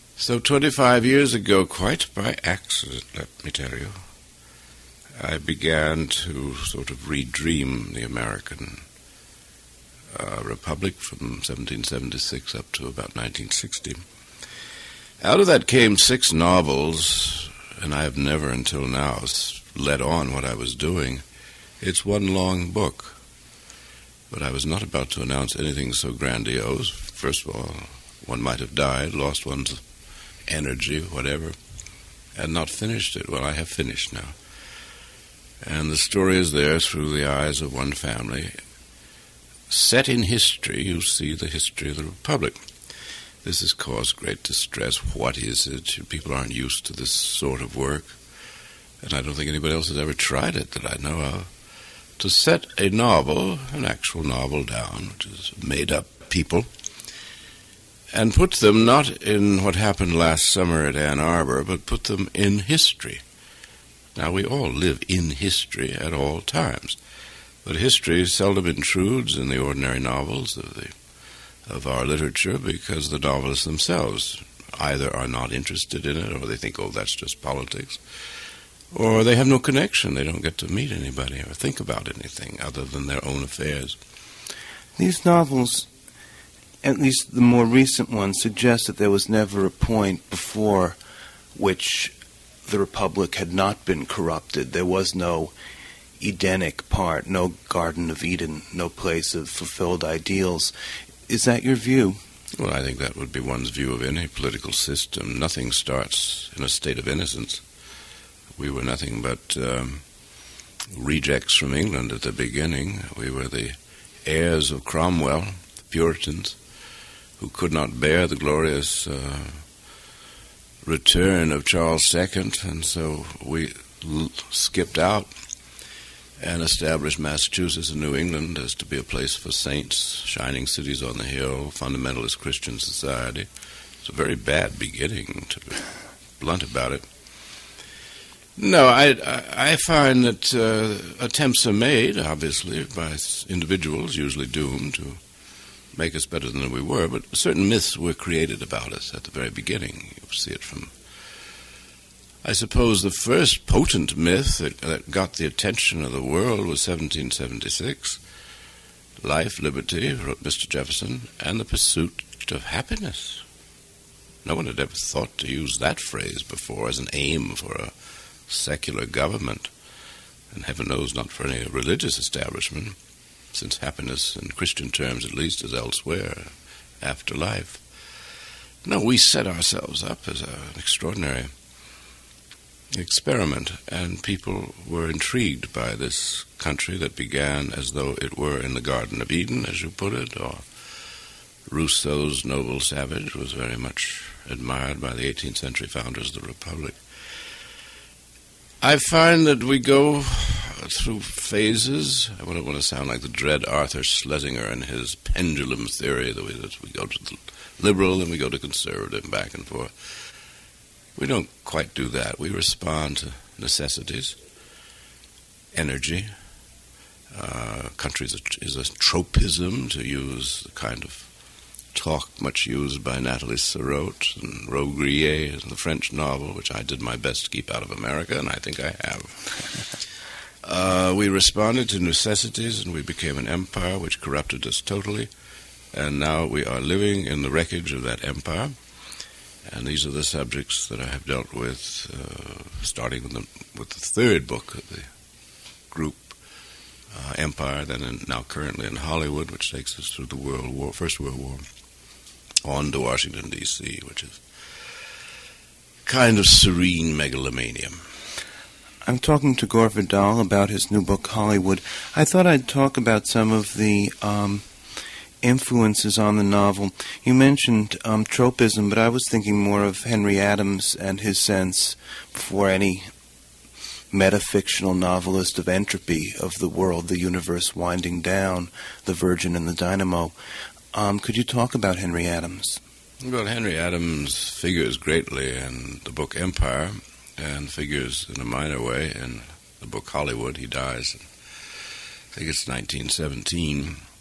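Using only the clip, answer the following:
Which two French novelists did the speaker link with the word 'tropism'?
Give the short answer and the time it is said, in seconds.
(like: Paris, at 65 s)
Nathalie Sarraute and Robbe-Grillet, at 223 s.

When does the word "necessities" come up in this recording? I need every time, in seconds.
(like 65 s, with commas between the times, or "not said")
213 s, 231 s.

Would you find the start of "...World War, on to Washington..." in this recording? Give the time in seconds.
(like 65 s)
251 s.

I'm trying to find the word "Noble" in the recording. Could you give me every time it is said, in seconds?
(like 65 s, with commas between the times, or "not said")
192 s.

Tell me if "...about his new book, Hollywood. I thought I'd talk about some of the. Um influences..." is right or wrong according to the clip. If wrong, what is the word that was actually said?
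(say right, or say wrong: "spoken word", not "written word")
right.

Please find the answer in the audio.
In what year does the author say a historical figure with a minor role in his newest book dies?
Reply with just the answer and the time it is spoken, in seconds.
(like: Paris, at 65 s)
1917, at 292 s.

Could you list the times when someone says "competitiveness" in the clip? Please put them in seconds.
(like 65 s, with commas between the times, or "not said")
not said.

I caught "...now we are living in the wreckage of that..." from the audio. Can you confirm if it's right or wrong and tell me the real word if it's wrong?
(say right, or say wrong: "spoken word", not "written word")
right.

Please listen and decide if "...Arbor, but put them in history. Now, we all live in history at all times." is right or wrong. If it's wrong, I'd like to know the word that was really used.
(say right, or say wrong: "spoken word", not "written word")
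right.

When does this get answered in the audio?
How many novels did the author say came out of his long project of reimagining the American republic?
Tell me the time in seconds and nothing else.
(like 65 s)
15 s.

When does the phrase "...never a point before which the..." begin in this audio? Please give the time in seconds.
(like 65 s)
89 s.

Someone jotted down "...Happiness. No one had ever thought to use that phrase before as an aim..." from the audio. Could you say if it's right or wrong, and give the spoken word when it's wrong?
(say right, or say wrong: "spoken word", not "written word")
right.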